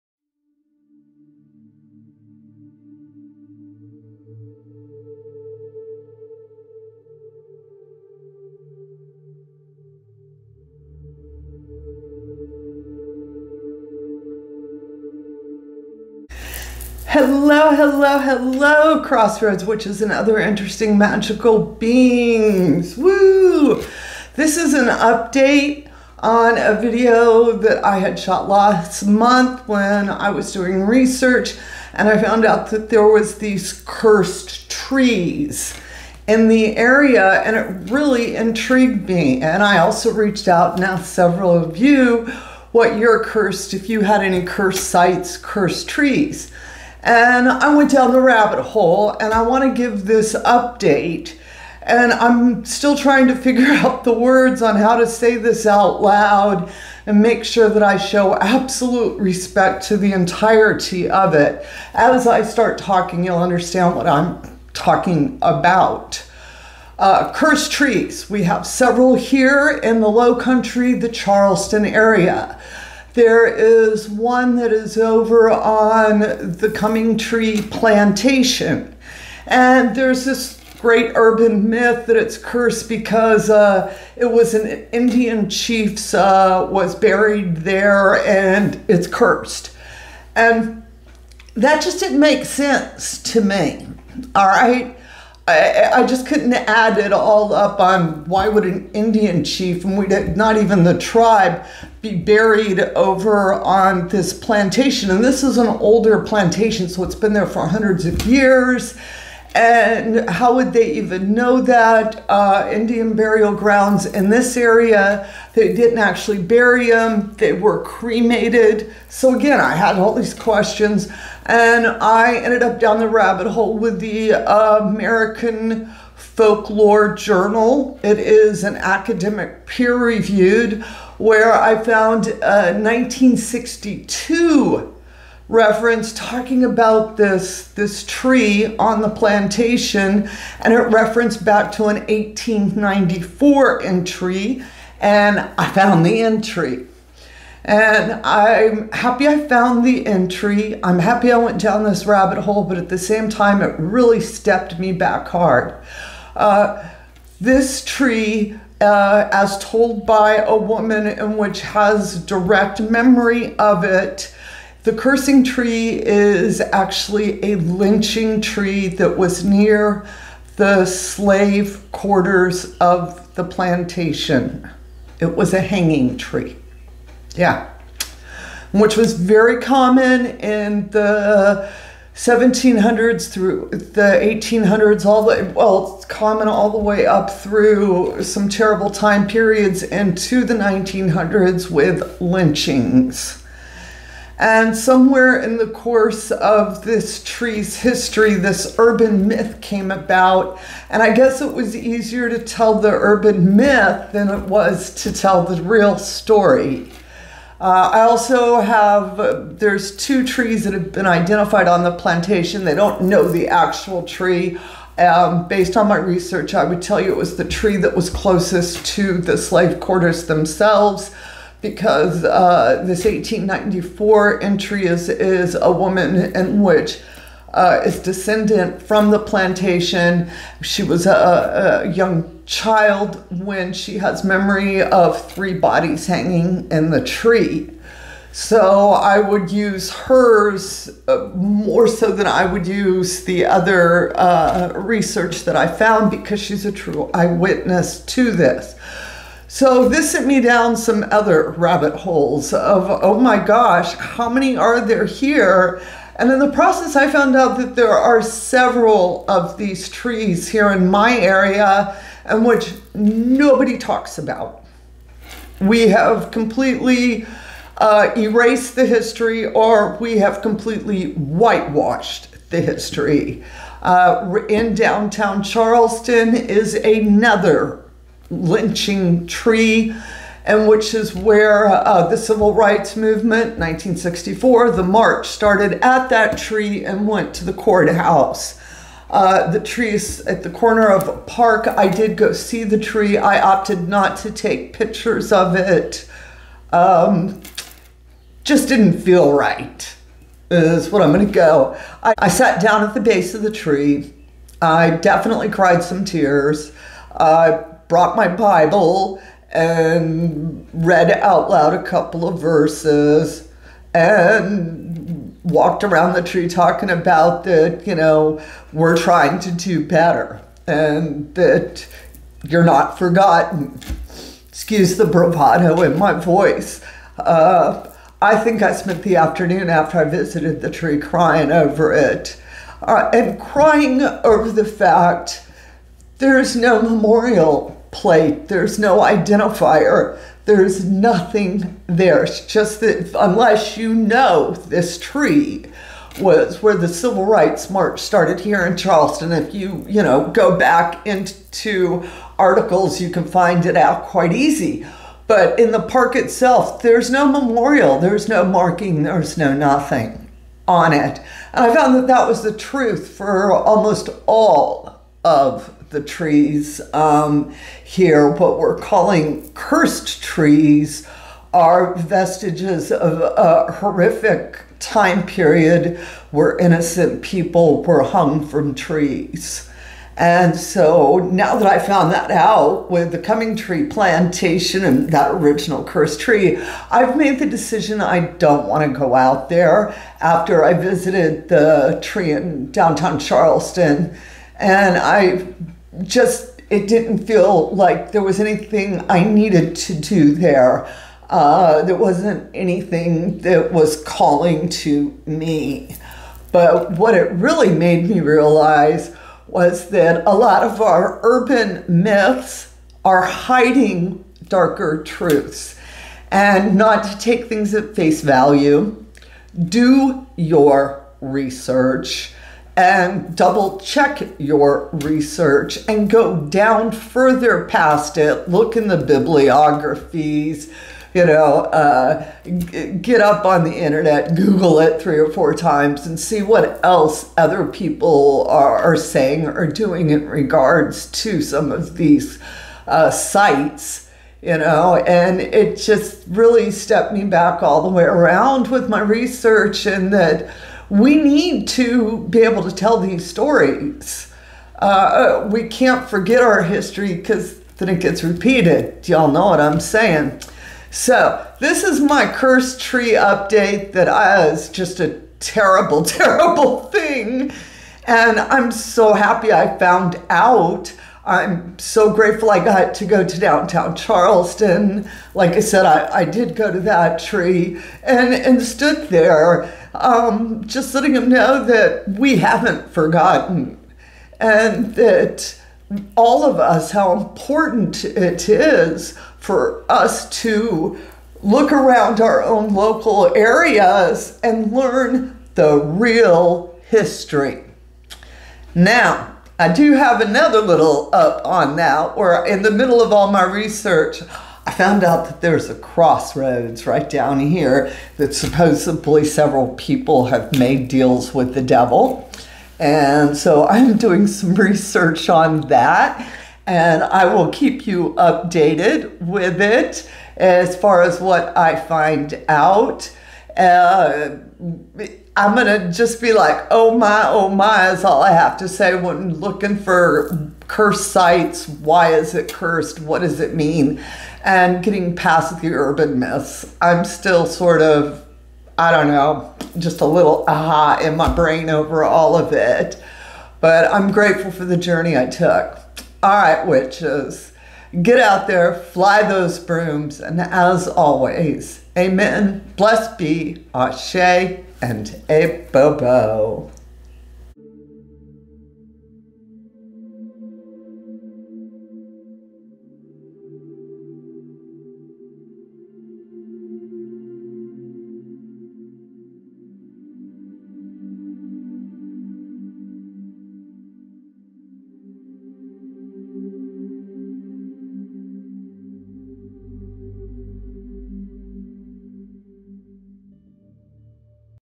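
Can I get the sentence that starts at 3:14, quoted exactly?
And somewhere in the course of this tree's history, this urban myth came about.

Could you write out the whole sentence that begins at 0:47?
And I went down the rabbit hole and I want to give this update.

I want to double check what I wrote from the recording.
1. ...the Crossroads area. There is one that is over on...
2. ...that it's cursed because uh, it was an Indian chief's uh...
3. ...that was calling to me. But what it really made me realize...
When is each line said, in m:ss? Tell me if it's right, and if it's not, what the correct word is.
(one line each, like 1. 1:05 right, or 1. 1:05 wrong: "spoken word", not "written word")
1. 1:10 wrong: "Charleston", not "Crossroads"
2. 1:22 right
3. 6:43 right.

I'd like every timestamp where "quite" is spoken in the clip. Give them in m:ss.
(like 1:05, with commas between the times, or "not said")
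5:54.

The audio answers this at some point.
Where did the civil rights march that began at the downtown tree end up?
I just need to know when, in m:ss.
4:47.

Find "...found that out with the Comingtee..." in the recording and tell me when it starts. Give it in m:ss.
6:21.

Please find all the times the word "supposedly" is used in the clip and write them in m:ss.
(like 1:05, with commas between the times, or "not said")
8:28.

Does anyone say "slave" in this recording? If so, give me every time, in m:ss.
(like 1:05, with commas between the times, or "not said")
2:50, 3:39.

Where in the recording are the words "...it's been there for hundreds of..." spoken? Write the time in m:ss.
1:47.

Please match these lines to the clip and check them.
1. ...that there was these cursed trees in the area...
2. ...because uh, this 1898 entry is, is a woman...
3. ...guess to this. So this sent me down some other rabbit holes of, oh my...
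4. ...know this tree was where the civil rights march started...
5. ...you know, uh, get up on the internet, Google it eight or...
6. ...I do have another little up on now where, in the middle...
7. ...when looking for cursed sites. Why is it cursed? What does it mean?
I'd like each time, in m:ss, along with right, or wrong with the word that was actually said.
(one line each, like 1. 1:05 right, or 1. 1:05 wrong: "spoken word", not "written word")
1. 0:32 right
2. 3:41 wrong: "1894", not "1898"
3. 4:07 wrong: "eyewitness", not "guess"
4. 5:43 right
5. 7:11 wrong: "three", not "eight"
6. 8:19 right
7. 8:48 right.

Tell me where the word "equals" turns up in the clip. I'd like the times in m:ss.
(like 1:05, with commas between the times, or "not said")
not said.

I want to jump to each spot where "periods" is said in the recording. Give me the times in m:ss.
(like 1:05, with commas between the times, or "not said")
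3:09, 6:15.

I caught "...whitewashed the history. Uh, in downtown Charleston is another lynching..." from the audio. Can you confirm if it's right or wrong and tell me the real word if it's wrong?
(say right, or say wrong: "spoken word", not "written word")
right.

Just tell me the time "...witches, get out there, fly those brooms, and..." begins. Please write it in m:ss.
9:06.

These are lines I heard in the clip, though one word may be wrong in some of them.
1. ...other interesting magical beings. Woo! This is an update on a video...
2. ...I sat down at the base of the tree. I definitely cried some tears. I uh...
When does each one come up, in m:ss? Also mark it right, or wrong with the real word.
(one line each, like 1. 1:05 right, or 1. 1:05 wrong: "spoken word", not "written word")
1. 0:20 right
2. 5:02 right.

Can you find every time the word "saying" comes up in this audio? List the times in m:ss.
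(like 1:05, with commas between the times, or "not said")
7:18, 7:39.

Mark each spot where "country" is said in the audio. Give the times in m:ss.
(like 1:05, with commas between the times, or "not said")
1:10.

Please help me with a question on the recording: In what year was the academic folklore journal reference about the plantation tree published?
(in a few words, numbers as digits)
1962.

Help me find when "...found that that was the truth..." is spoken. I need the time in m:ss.
6:01.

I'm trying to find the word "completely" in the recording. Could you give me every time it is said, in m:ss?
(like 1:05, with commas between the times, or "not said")
4:26, 4:30.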